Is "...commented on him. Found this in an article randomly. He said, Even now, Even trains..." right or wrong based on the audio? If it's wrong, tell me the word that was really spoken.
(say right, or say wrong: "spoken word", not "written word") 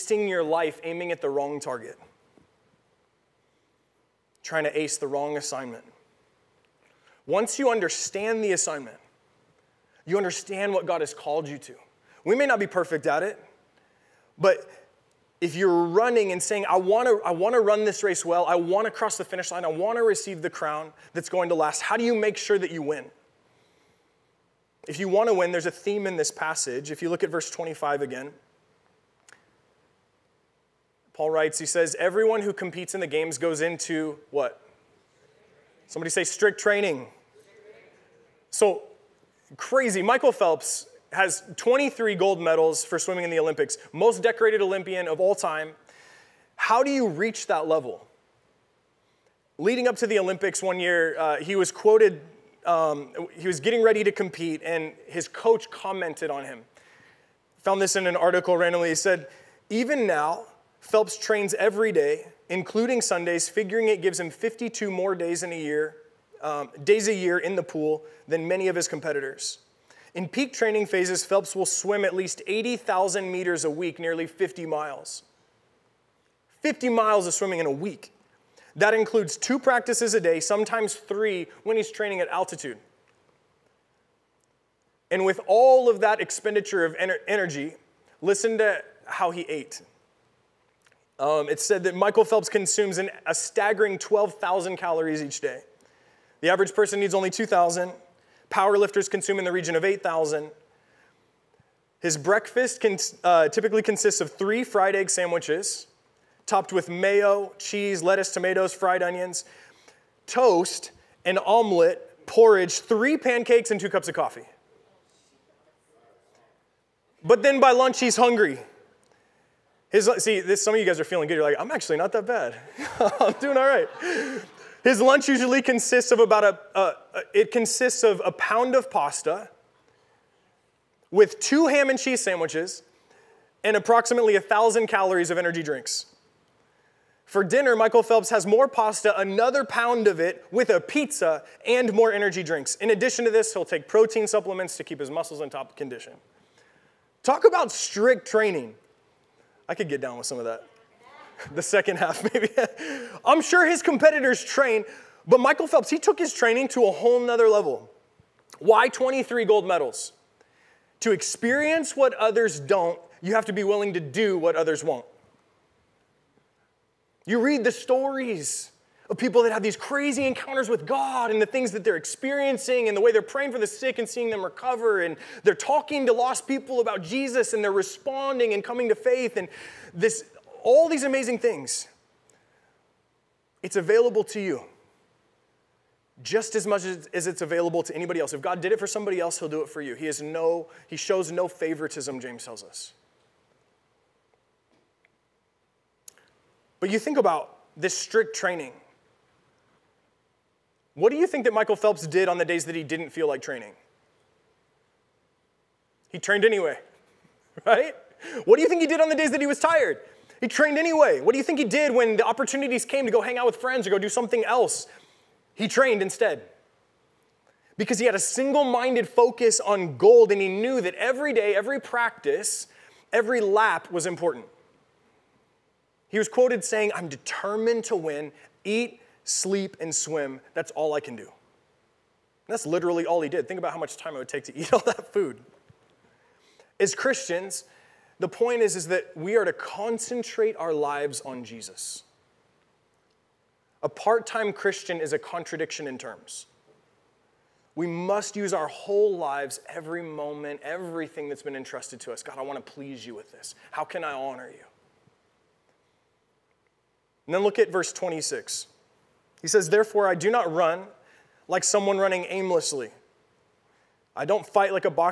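wrong: "Phelps", not "Even".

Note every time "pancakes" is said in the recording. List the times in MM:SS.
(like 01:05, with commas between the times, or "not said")
01:53.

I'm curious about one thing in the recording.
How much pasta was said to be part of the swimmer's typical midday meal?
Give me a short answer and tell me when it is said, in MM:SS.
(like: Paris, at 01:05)
A pound, at 02:08.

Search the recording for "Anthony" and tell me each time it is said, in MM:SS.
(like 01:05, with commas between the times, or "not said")
not said.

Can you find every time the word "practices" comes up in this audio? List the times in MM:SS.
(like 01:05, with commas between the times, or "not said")
01:19, 03:41.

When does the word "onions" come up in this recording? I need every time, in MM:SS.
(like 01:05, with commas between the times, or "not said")
01:49.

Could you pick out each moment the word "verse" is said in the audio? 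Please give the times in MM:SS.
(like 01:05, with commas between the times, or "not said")
00:27, 04:17.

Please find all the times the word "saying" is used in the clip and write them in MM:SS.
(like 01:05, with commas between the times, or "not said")
00:16, 03:46.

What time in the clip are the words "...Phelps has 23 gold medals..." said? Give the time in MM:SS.
00:40.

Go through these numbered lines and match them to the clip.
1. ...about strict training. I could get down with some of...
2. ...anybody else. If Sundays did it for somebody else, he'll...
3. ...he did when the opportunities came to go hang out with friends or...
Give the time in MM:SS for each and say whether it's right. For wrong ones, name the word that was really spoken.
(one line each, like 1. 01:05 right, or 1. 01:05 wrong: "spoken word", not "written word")
1. 02:27 right
2. 03:07 wrong: "God", not "Sundays"
3. 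03:31 right.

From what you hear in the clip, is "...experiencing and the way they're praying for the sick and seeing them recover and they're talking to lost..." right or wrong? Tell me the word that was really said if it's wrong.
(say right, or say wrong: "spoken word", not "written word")
right.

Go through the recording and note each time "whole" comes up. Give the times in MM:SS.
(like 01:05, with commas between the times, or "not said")
02:36, 04:08.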